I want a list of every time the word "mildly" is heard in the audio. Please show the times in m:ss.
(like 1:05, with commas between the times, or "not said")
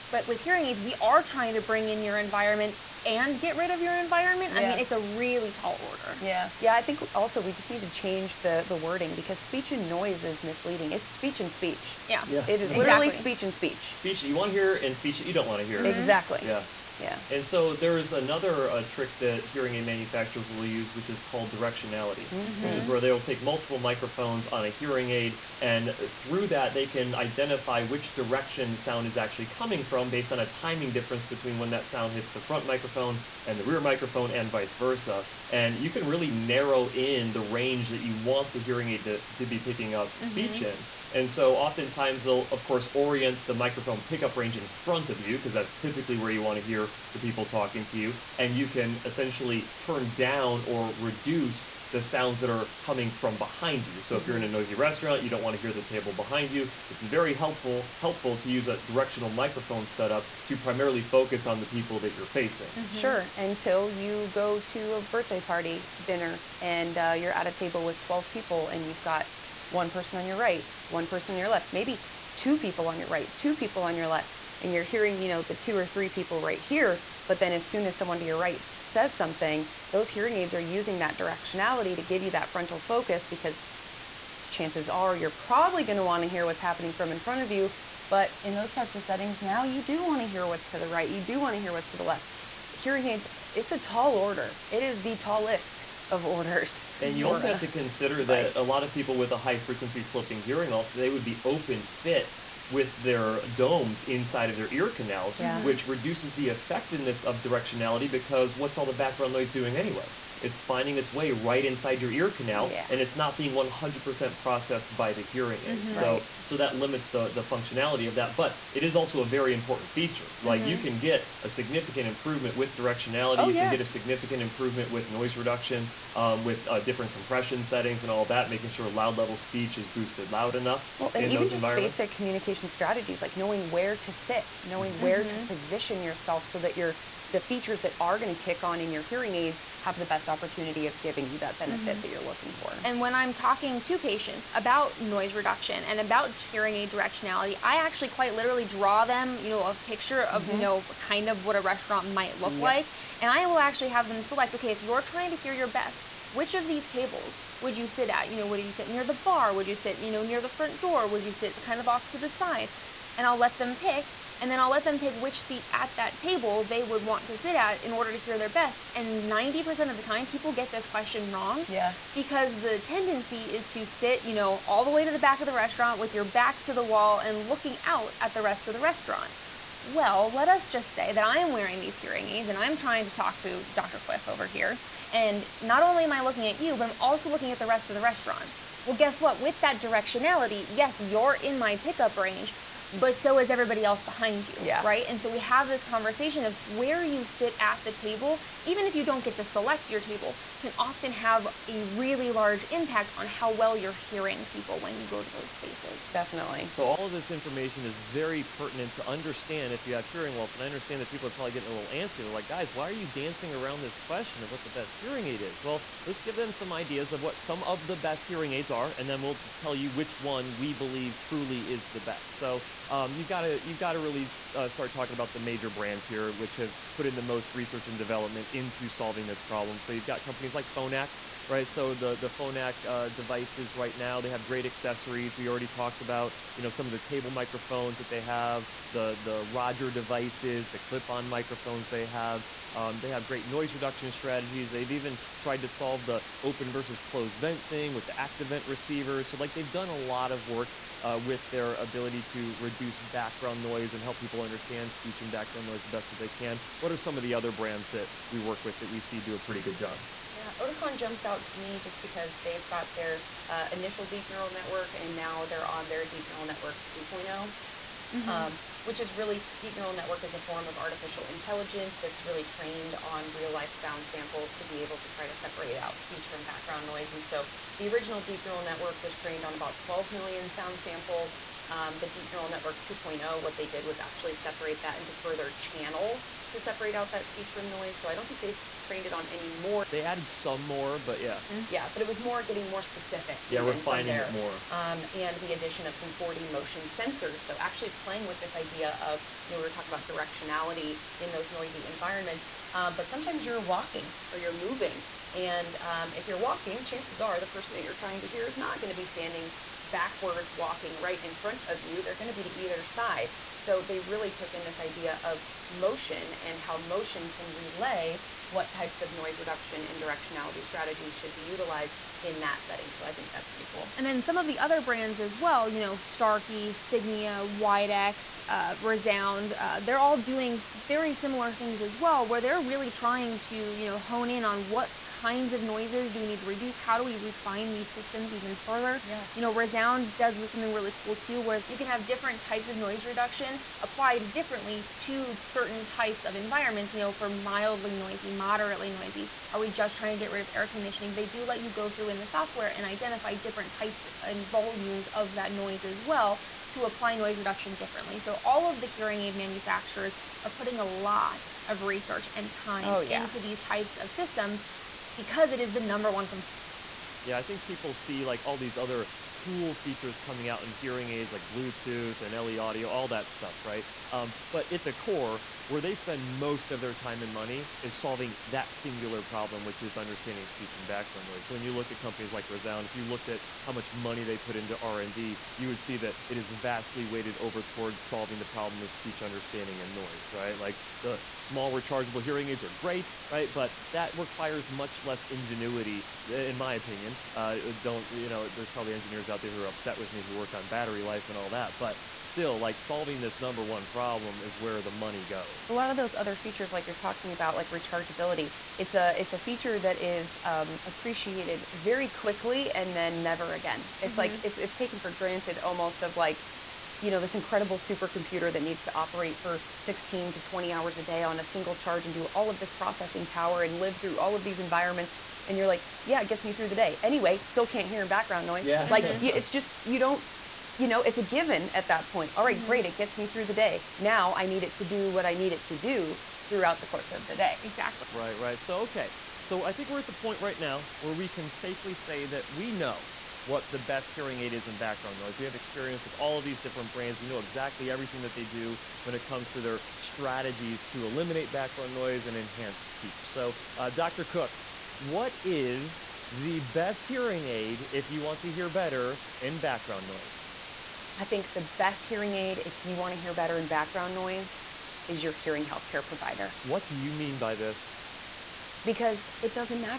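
5:47.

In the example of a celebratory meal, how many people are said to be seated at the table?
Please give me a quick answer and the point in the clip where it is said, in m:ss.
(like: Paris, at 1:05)
12, at 1:08.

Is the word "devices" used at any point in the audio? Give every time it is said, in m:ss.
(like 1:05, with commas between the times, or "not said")
3:53, 3:59.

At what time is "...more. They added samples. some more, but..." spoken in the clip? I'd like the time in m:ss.
4:49.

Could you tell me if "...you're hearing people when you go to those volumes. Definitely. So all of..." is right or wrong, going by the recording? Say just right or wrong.
wrong.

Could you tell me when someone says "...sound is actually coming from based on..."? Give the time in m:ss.
0:28.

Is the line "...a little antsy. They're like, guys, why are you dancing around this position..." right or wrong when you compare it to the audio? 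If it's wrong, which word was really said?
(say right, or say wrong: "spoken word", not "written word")
wrong: "question", not "position".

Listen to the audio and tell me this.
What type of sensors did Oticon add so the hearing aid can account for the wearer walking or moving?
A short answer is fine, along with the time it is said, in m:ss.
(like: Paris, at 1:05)
4D motion sensors, at 4:56.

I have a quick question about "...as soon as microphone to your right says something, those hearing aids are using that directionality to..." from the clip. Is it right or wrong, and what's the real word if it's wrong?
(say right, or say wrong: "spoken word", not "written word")
wrong: "someone", not "microphone".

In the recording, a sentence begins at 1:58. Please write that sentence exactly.
But it is also a very important feature.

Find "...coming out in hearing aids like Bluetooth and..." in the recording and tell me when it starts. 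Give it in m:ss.
6:10.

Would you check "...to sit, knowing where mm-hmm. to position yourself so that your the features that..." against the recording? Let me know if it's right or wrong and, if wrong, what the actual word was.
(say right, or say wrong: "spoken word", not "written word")
right.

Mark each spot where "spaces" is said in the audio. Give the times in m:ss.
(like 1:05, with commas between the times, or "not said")
3:25.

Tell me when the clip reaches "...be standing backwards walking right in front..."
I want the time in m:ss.
5:08.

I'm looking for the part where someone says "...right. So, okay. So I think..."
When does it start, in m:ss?
7:18.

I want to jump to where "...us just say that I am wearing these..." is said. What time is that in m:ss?
3:00.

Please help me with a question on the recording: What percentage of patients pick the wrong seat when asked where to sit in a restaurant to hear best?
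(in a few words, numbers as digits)
90%.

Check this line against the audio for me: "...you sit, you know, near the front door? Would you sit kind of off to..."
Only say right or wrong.
right.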